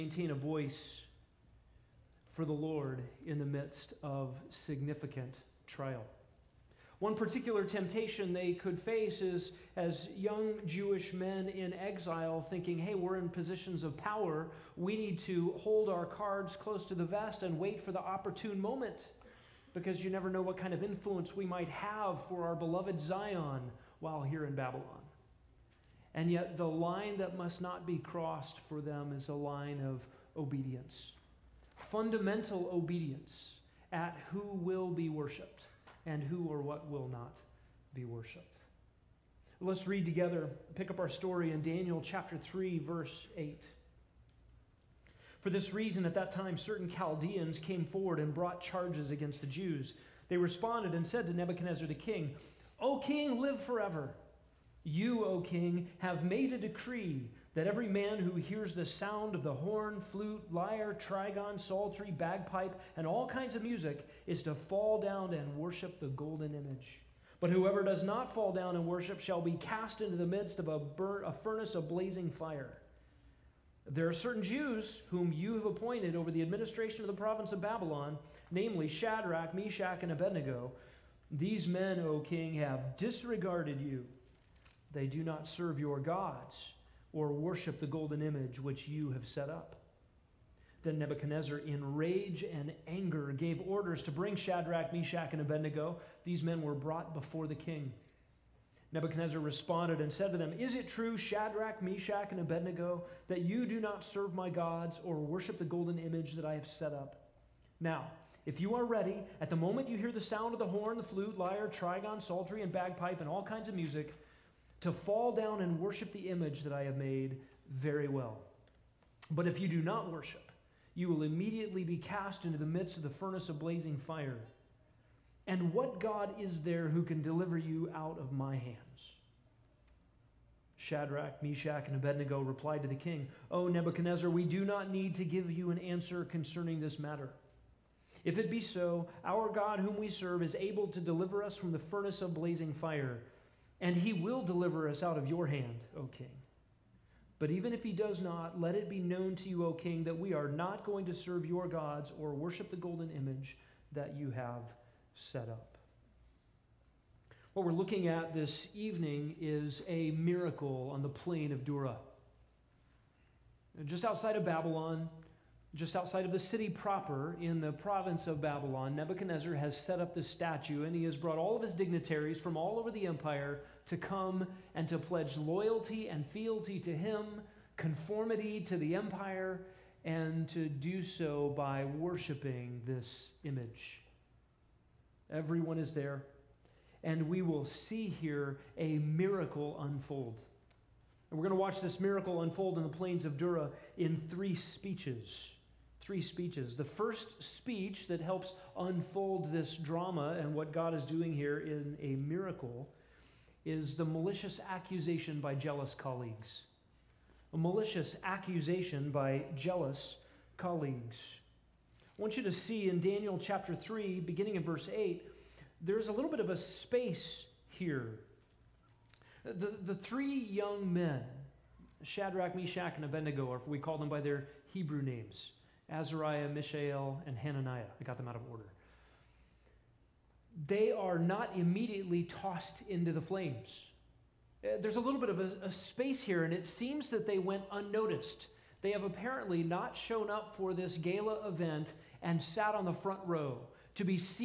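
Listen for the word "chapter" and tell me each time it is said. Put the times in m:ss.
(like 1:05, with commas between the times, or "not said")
0:42, 3:33.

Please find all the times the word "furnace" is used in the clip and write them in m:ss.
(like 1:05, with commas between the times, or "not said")
1:11, 2:03, 2:21.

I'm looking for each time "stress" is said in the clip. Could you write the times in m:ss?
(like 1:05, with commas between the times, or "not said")
not said.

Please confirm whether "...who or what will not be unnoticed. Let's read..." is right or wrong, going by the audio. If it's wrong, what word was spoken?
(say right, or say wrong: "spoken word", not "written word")
wrong: "worshiped", not "unnoticed".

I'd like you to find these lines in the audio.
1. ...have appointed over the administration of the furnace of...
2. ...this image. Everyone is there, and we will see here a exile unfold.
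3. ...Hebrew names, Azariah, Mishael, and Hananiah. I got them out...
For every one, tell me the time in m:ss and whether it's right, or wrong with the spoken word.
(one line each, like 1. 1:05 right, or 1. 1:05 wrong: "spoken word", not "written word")
1. 1:15 wrong: "province", not "furnace"
2. 3:02 wrong: "miracle", not "exile"
3. 3:44 right.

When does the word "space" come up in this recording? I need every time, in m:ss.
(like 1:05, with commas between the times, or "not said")
3:36, 3:55.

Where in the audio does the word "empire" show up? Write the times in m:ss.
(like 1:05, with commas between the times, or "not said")
2:53, 2:58.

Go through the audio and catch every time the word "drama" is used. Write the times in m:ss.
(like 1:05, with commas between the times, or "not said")
3:19.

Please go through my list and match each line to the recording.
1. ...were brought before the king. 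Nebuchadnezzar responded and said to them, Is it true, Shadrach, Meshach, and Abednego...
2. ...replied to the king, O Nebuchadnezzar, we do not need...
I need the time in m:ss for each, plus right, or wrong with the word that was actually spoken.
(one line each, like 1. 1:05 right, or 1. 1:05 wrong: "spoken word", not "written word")
1. 1:36 right
2. 2:12 right.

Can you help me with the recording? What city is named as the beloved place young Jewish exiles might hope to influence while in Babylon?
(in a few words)
Zion.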